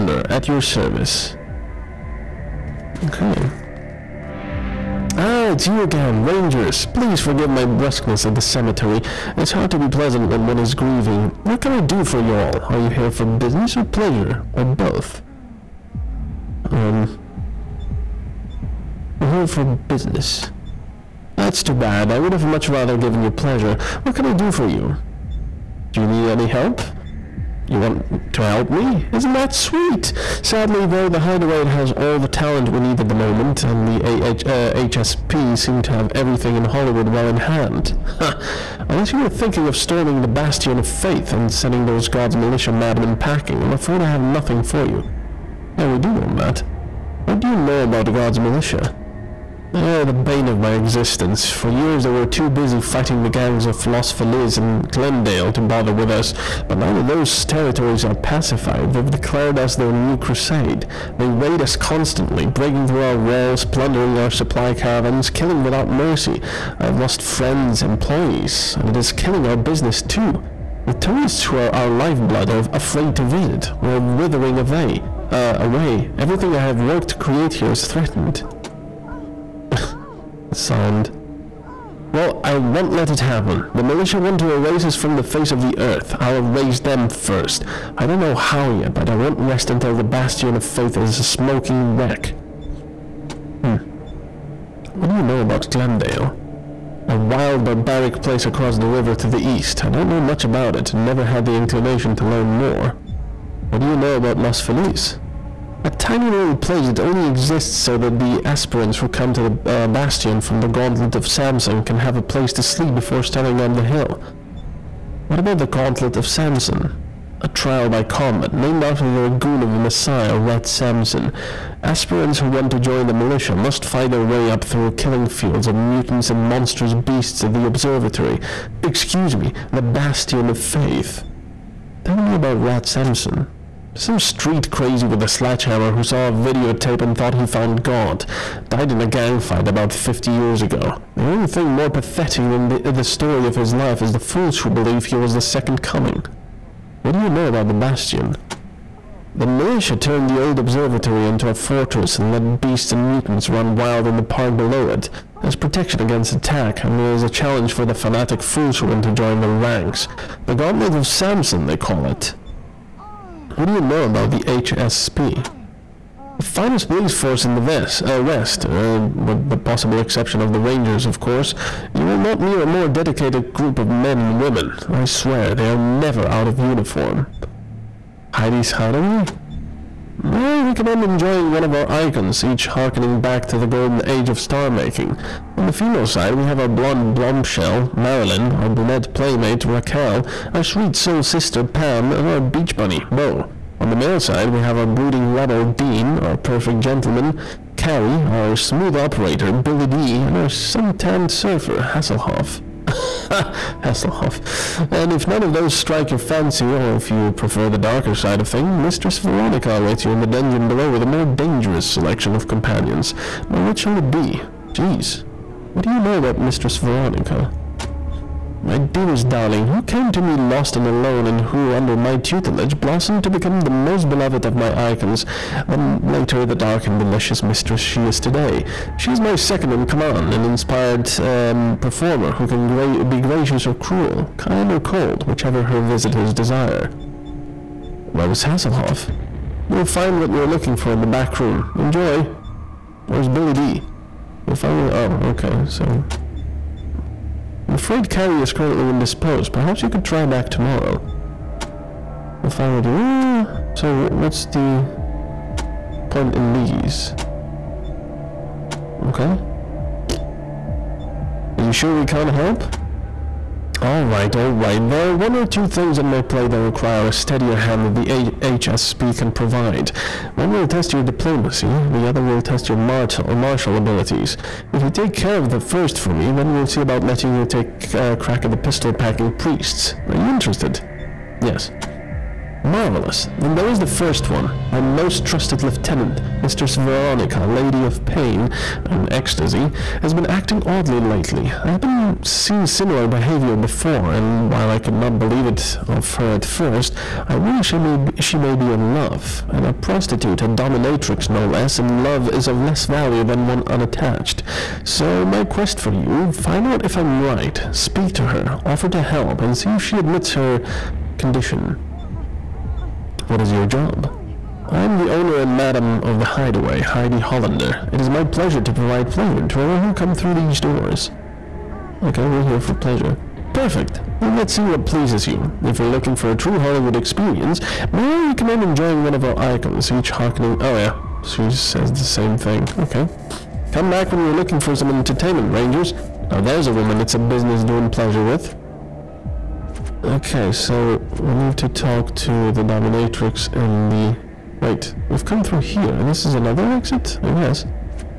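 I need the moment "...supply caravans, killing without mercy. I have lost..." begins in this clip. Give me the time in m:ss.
1:04.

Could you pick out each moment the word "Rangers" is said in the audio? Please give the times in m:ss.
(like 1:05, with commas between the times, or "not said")
0:06, 2:50, 5:35.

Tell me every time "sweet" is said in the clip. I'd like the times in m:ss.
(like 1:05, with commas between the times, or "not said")
0:29, 3:10.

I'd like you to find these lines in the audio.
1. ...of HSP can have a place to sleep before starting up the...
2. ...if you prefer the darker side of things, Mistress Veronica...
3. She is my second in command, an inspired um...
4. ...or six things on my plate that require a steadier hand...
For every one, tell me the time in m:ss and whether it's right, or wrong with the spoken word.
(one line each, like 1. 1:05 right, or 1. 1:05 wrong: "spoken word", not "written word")
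1. 1:51 wrong: "Samson", not "HSP"
2. 3:26 right
3. 3:48 right
4. 4:25 wrong: "two", not "six".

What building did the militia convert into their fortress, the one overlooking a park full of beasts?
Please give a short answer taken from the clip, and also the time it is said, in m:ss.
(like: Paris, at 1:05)
the old observatory, at 2:30.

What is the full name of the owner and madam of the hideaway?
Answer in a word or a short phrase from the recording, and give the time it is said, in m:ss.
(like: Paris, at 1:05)
Heidi Hollander, at 5:16.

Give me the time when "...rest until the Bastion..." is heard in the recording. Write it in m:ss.
1:29.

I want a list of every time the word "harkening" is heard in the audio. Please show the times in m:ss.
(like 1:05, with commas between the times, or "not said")
3:02, 5:30.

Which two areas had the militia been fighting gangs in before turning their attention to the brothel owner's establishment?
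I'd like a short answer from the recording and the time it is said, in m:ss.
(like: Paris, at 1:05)
Los Feliz and Glendale, at 0:53.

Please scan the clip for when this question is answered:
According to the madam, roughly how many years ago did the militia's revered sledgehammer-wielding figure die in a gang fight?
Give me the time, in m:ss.
2:19.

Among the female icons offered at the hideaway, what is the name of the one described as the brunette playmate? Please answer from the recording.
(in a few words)
Raquel.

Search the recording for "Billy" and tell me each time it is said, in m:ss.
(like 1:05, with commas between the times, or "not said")
3:19, 4:03.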